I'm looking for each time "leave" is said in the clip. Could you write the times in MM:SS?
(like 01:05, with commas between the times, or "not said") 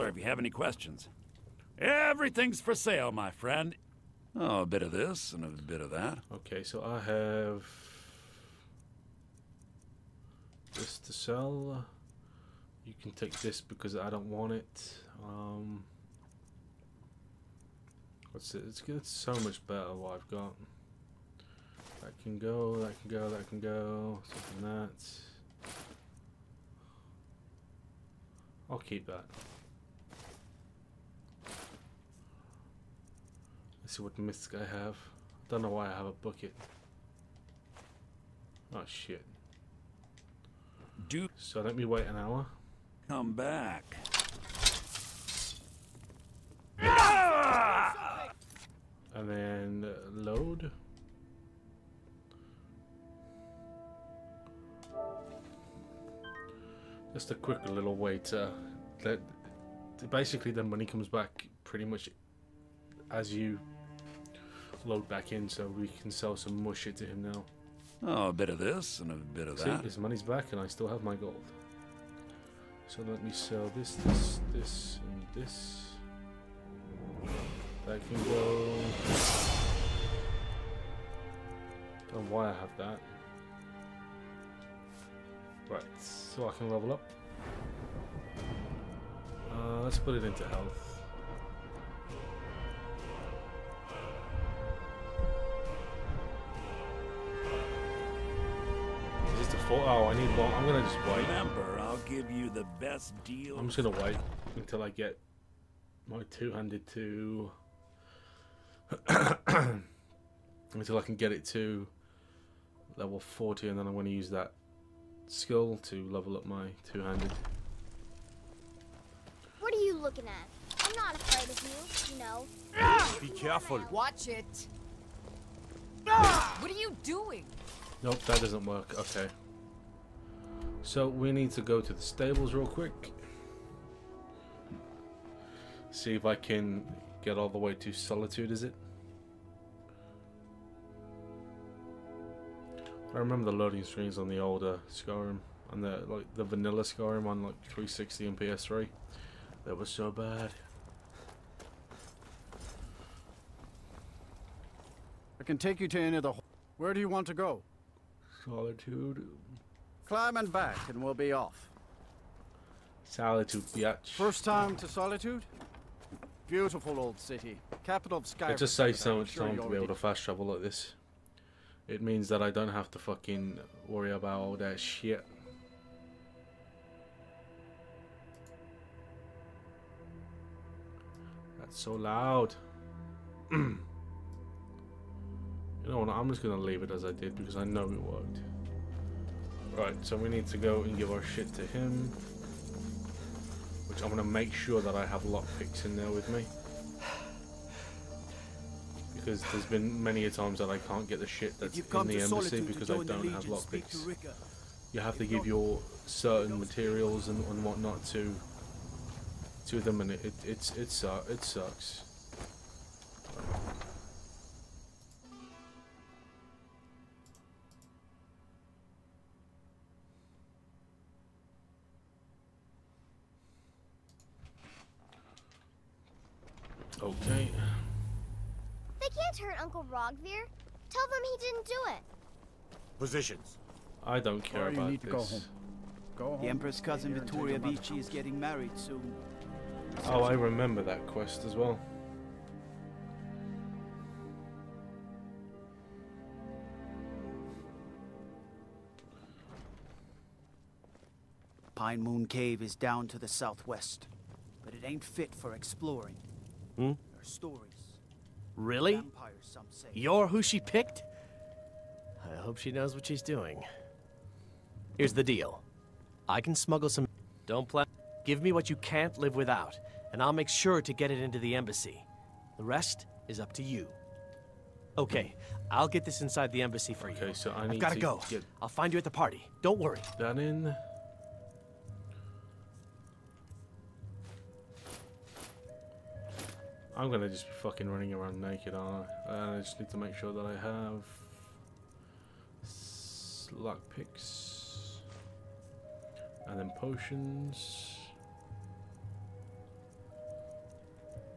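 03:06.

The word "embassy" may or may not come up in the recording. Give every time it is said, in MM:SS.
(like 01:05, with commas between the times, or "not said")
03:22, 04:31, 04:36.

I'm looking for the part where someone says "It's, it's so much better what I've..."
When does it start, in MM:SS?
00:18.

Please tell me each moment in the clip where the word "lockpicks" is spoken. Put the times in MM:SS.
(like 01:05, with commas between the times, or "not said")
03:15, 03:23.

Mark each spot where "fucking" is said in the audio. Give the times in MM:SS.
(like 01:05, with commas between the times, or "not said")
02:52, 04:47.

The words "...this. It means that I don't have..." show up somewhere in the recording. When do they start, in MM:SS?
02:50.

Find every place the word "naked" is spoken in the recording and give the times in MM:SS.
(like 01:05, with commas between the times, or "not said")
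04:48.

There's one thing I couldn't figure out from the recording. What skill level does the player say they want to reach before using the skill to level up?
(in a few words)
40.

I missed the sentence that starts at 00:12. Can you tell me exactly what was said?
You can take this because I don't want it.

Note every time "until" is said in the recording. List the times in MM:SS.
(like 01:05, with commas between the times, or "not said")
01:44, 01:50.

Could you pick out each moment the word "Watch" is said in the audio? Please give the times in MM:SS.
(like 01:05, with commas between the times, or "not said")
02:03.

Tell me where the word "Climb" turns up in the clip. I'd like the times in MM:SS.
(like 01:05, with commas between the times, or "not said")
02:40.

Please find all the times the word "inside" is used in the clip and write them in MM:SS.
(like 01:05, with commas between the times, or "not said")
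04:36.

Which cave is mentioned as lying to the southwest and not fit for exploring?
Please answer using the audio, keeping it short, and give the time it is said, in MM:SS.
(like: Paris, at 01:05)
Pine Moon Cave, at 04:11.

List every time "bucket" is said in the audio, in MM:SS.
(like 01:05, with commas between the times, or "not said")
00:36.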